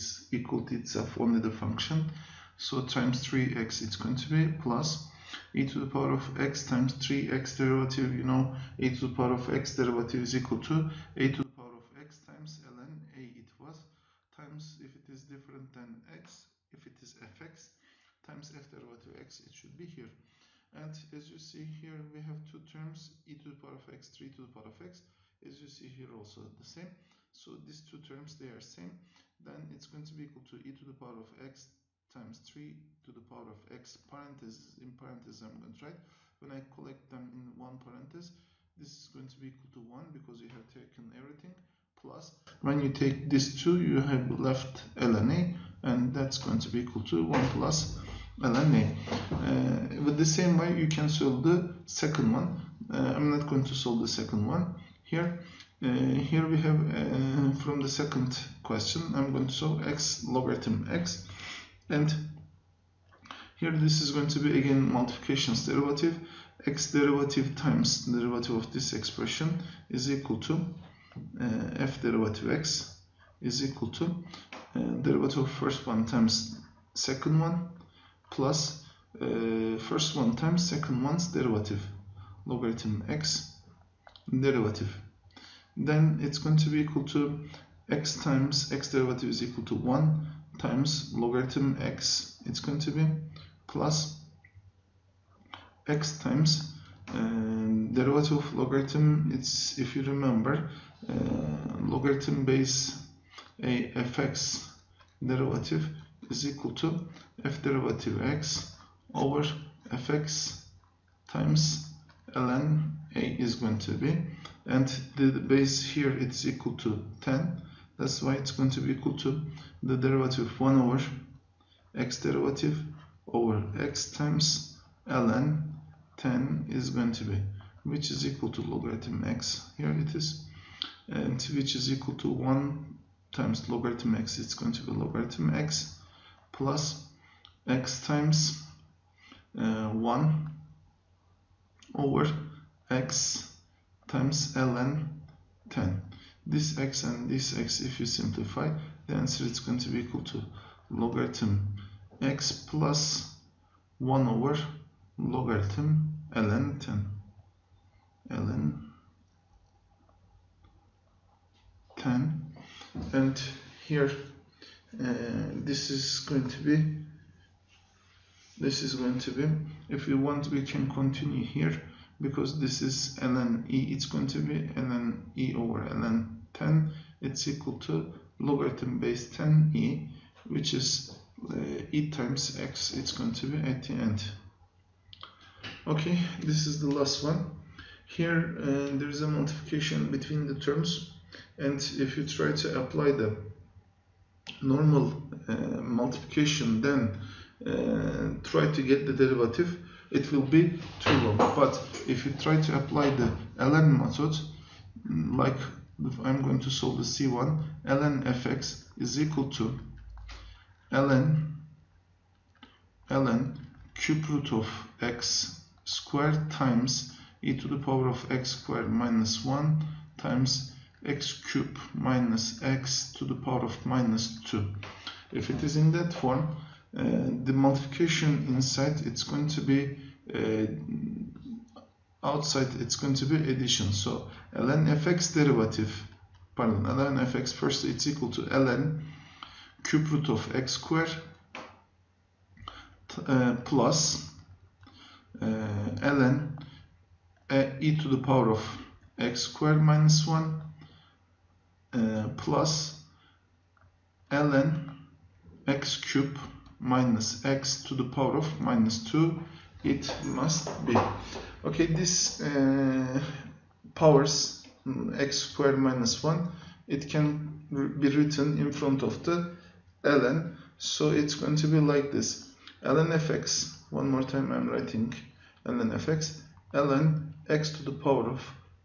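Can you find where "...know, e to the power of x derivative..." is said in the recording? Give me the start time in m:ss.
0:08.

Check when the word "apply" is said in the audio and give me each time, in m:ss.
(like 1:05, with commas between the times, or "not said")
3:12, 3:22.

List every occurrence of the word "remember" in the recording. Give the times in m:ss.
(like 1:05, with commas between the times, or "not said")
1:40.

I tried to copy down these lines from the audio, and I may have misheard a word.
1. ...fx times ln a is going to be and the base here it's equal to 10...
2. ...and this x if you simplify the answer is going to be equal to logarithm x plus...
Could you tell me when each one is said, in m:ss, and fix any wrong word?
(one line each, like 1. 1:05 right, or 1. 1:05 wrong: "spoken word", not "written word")
1. 1:49 right
2. 2:27 right.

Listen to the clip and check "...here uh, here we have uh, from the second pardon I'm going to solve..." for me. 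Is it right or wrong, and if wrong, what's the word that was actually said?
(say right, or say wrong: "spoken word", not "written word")
wrong: "question", not "pardon".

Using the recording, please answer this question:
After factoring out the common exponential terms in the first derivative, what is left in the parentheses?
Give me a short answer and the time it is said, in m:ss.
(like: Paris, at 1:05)
1 + ln a, at 0:47.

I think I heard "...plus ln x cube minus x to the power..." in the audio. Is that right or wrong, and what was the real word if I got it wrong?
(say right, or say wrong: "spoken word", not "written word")
right.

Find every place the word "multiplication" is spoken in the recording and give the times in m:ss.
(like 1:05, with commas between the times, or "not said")
1:04, 3:09, 3:15, 3:47.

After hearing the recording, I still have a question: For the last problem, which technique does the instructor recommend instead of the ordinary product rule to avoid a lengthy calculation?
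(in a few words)
the ln method.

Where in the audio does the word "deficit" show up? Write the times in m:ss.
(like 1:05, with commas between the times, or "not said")
not said.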